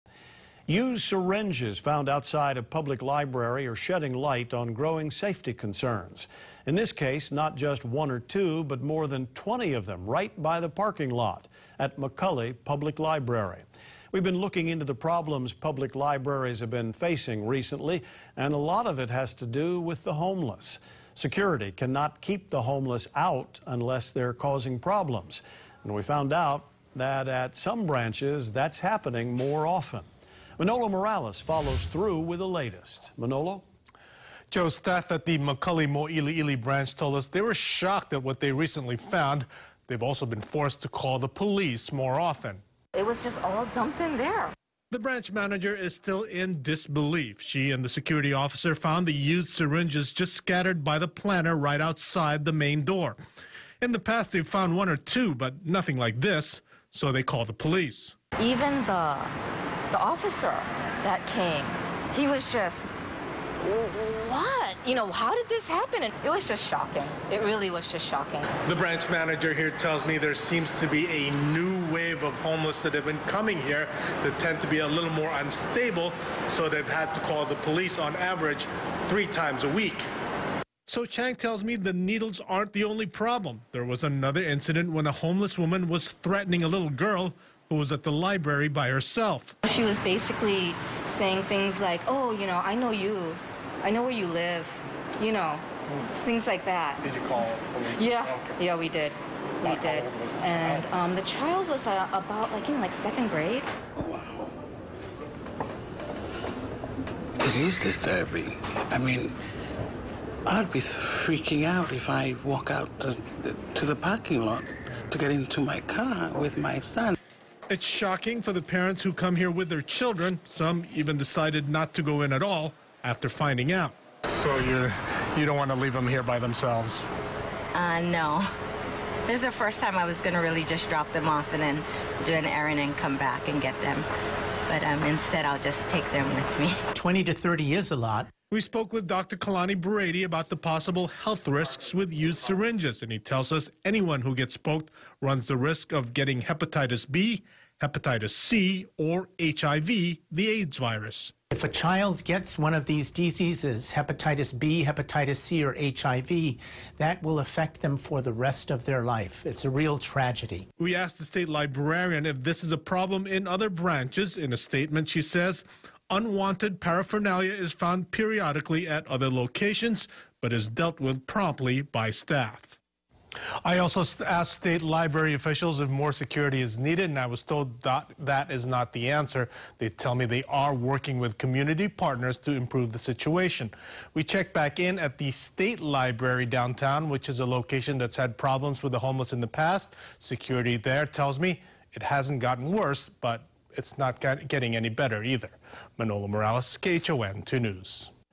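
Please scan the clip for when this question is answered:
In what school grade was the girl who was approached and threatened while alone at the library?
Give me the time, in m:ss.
1:42.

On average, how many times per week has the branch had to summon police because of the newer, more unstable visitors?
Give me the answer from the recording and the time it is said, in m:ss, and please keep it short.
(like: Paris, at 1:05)
3, at 1:19.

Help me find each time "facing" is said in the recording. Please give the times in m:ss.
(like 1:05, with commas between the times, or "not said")
0:16.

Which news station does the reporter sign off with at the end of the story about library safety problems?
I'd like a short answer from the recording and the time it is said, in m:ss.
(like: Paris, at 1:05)
KHON 2 News, at 3:16.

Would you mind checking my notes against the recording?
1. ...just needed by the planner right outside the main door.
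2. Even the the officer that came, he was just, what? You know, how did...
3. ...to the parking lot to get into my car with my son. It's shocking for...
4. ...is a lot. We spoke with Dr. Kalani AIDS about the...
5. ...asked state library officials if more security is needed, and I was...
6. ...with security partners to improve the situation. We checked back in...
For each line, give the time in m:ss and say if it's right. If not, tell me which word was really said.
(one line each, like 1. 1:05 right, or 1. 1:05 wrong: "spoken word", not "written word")
1. 0:50 wrong: "scattered", not "needed"
2. 0:58 right
3. 1:53 right
4. 2:17 wrong: "Brady", not "AIDS"
5. 2:54 right
6. 3:01 wrong: "community", not "security".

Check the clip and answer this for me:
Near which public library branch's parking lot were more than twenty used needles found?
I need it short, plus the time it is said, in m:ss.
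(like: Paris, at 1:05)
McCully Public Library, at 0:11.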